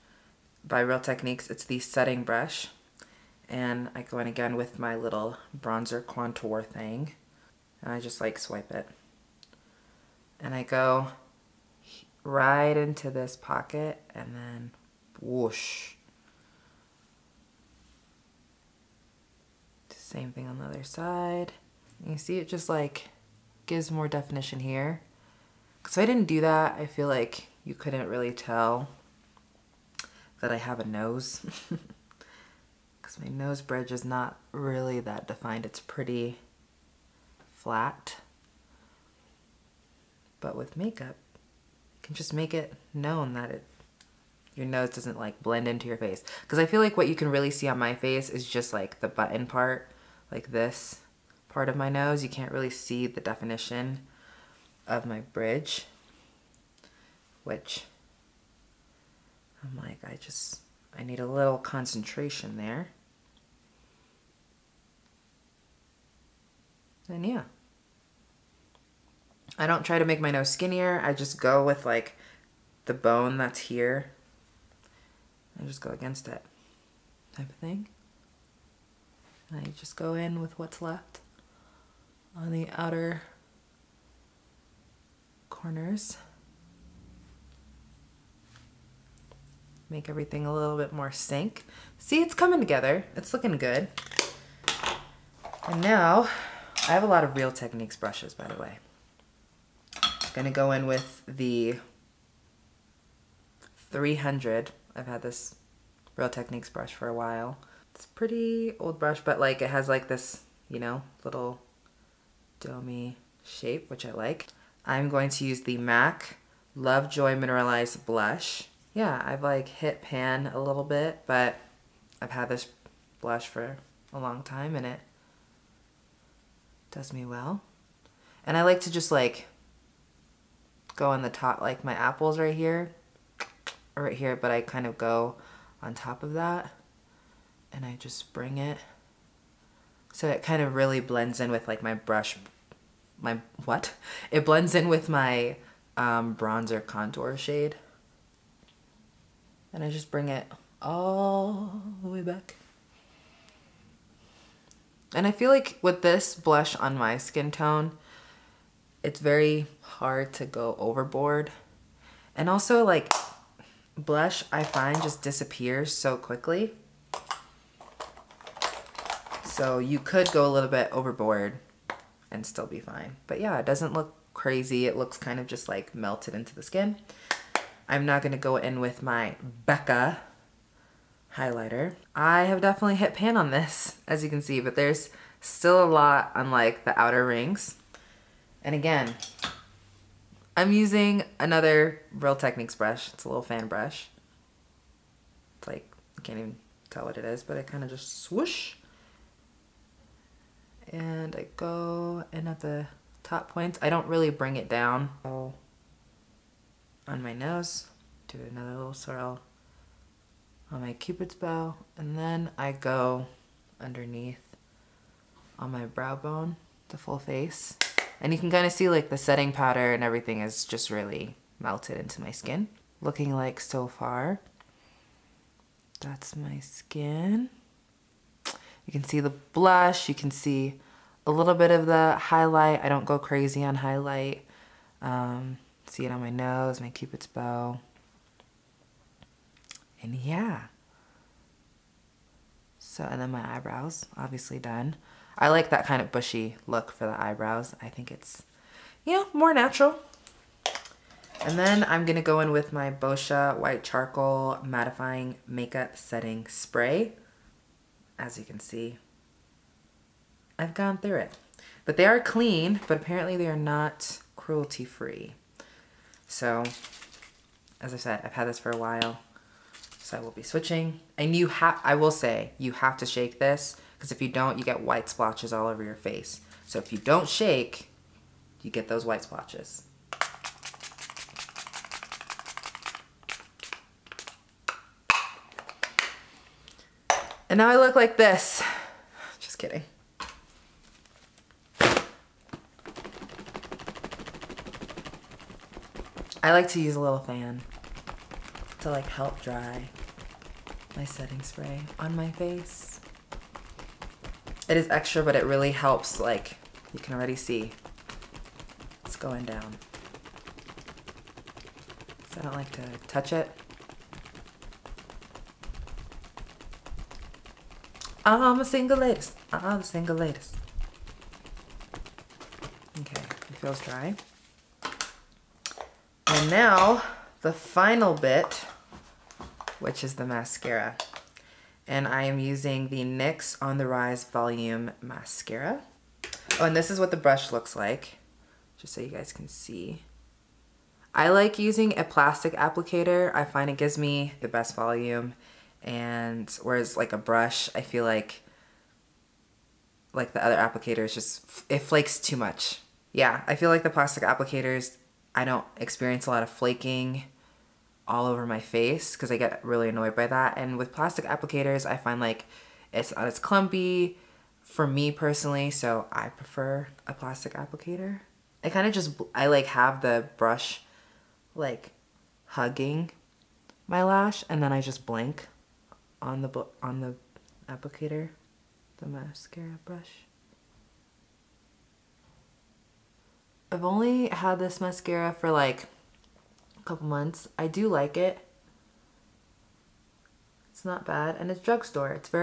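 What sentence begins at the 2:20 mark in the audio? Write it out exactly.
So it kind of really blends in with like my brush, my, what?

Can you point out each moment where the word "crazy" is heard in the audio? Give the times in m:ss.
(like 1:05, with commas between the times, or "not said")
2:54, 3:53.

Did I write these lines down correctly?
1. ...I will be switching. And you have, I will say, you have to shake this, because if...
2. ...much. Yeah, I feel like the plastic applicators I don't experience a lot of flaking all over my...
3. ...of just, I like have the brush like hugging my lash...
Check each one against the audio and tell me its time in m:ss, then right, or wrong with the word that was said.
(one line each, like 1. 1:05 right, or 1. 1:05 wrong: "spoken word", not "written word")
1. 4:30 right
2. 5:52 right
3. 6:08 right.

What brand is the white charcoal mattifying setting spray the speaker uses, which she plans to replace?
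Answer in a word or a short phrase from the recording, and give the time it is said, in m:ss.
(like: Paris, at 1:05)
Boscia, at 4:12.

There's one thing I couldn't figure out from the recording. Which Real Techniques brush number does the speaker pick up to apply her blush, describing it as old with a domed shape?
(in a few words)
300.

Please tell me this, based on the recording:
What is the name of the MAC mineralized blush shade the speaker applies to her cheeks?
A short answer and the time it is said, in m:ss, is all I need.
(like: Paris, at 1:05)
Love Joy, at 1:56.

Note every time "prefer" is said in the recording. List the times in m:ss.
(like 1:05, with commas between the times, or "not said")
6:06.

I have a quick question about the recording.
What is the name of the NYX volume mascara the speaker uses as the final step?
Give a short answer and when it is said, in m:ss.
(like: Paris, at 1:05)
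On The Rise, at 5:33.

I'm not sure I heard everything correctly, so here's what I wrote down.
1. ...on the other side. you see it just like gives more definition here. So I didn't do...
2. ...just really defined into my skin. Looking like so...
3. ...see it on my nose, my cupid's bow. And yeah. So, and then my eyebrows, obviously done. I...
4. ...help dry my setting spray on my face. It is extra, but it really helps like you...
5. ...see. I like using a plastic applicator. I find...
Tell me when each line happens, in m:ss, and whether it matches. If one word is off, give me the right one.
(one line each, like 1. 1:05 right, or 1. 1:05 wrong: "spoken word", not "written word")
1. 0:20 right
2. 3:40 wrong: "melted", not "defined"
3. 3:55 right
4. 4:59 right
5. 5:39 right.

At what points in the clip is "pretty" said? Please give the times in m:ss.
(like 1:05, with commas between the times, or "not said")
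0:35, 1:48.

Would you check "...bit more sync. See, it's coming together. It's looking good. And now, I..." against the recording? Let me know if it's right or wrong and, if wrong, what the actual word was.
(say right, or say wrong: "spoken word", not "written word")
right.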